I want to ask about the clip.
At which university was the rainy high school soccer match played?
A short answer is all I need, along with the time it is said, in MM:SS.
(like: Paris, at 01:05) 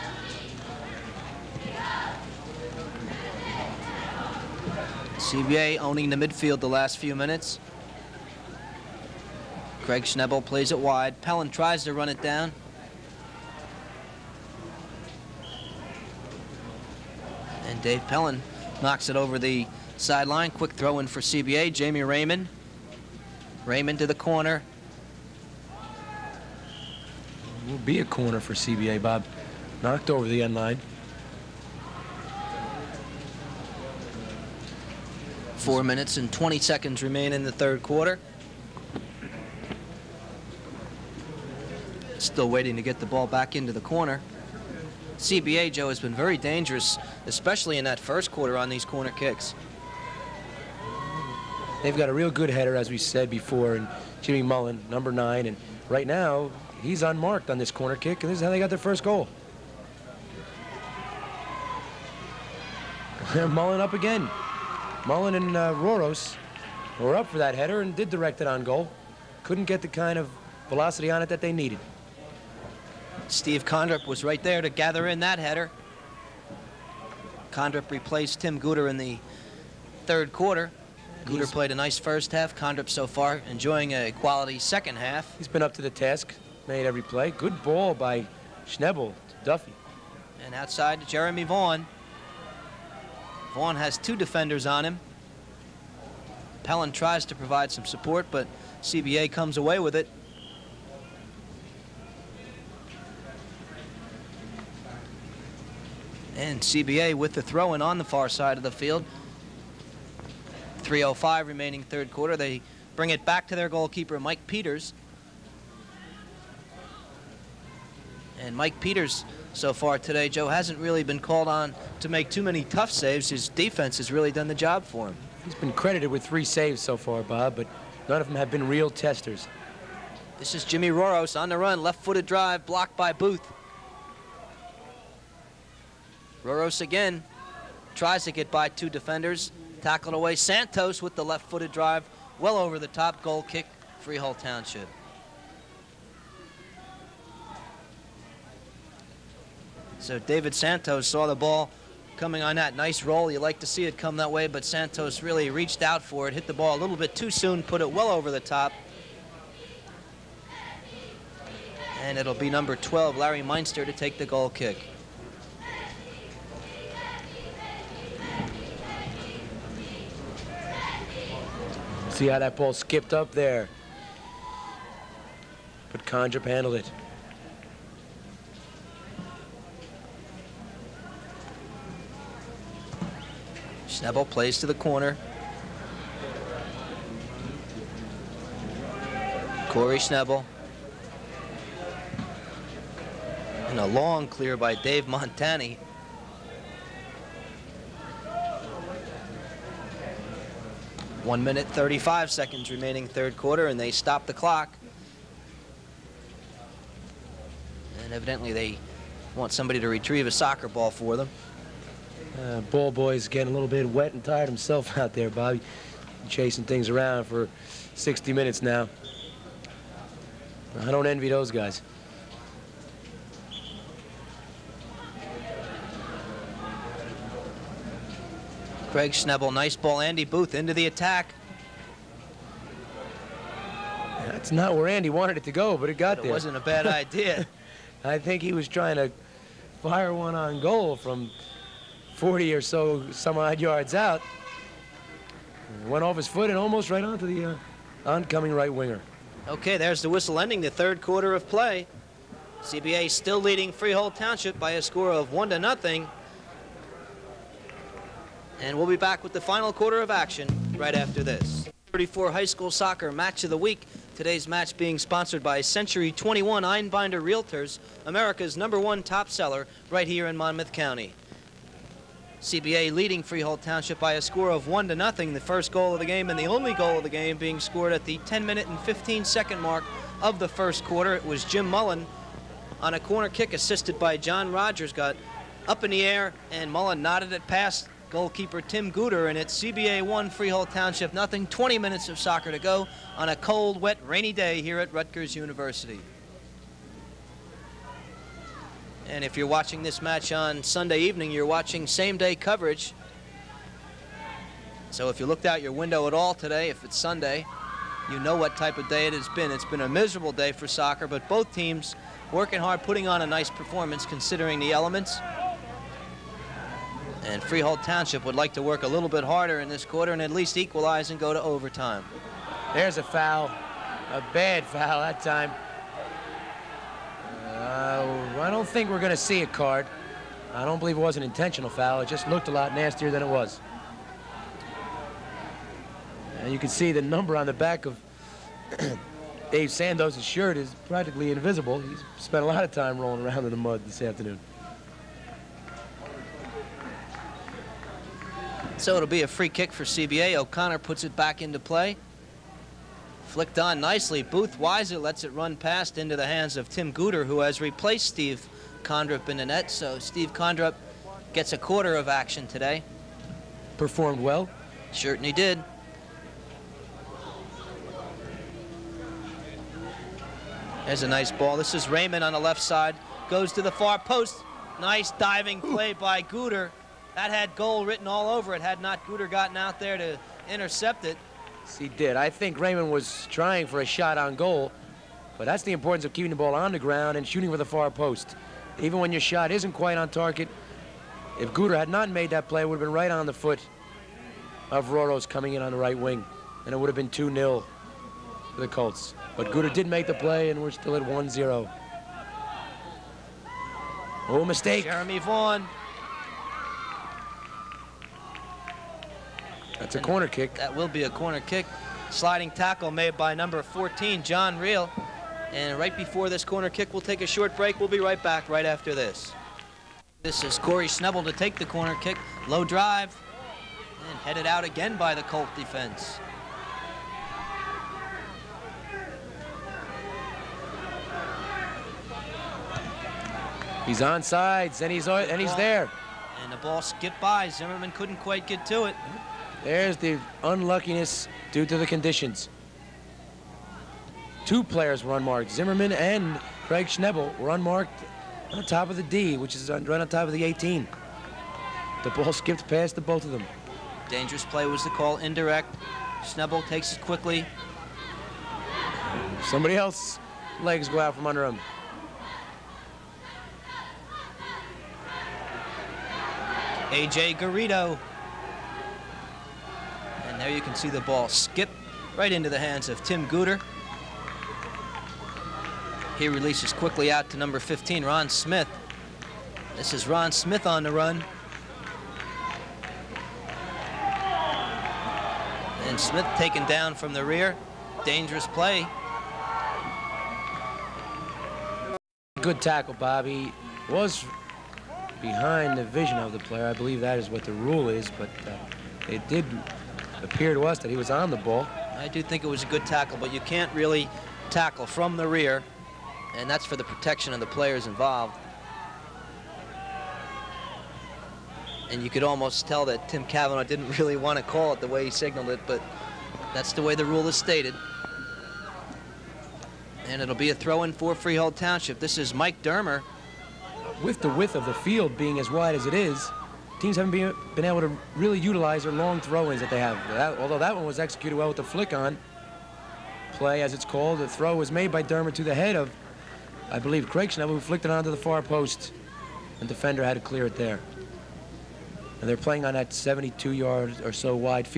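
Rutgers University, at 04:54.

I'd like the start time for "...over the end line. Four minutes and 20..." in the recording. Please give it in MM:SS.
00:30.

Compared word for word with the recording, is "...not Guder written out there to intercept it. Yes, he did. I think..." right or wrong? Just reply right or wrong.
wrong.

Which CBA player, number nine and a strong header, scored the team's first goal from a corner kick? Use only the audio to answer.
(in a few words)
Jimmy Mullen.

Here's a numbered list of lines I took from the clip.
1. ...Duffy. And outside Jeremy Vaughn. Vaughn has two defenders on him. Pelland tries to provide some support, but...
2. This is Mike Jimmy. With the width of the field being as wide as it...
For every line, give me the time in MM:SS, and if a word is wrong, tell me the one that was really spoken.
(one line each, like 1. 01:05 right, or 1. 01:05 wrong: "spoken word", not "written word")
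1. 01:29 right
2. 08:41 wrong: "Dermer", not "Jimmy".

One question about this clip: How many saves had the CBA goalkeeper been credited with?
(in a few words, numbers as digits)
3.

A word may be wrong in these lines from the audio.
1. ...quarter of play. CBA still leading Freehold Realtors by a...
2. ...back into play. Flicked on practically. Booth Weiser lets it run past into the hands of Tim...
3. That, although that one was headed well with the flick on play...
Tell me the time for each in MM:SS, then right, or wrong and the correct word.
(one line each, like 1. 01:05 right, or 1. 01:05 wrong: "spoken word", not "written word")
1. 04:11 wrong: "Township", not "Realtors"
2. 05:51 wrong: "nicely", not "practically"
3. 08:50 wrong: "executed", not "headed".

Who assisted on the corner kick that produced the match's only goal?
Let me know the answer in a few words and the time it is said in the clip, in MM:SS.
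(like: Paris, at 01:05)
John Rogers, at 04:44.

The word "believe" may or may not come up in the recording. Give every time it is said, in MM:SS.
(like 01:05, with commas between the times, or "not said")
05:30, 08:16, 08:56.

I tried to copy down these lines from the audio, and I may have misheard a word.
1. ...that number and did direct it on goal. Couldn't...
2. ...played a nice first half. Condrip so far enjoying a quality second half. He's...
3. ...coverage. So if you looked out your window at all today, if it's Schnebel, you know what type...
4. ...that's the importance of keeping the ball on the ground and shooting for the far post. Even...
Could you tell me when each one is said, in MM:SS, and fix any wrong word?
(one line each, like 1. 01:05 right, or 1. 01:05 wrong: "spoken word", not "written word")
1. 01:07 wrong: "header", not "number"
2. 01:21 right
3. 05:02 wrong: "Sunday", not "Schnebel"
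4. 06:25 right.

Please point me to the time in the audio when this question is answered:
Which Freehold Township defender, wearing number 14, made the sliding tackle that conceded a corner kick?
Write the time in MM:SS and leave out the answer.
06:54.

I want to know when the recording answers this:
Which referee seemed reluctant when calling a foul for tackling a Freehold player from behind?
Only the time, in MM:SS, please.
08:33.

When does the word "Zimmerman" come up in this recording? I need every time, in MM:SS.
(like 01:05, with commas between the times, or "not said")
07:17, 07:25.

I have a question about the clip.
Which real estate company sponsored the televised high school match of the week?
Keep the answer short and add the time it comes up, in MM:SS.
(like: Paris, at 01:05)
Century 21 Einbinder Realtors, at 04:25.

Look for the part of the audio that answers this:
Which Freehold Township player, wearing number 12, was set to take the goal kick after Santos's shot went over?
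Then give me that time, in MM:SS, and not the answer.
02:43.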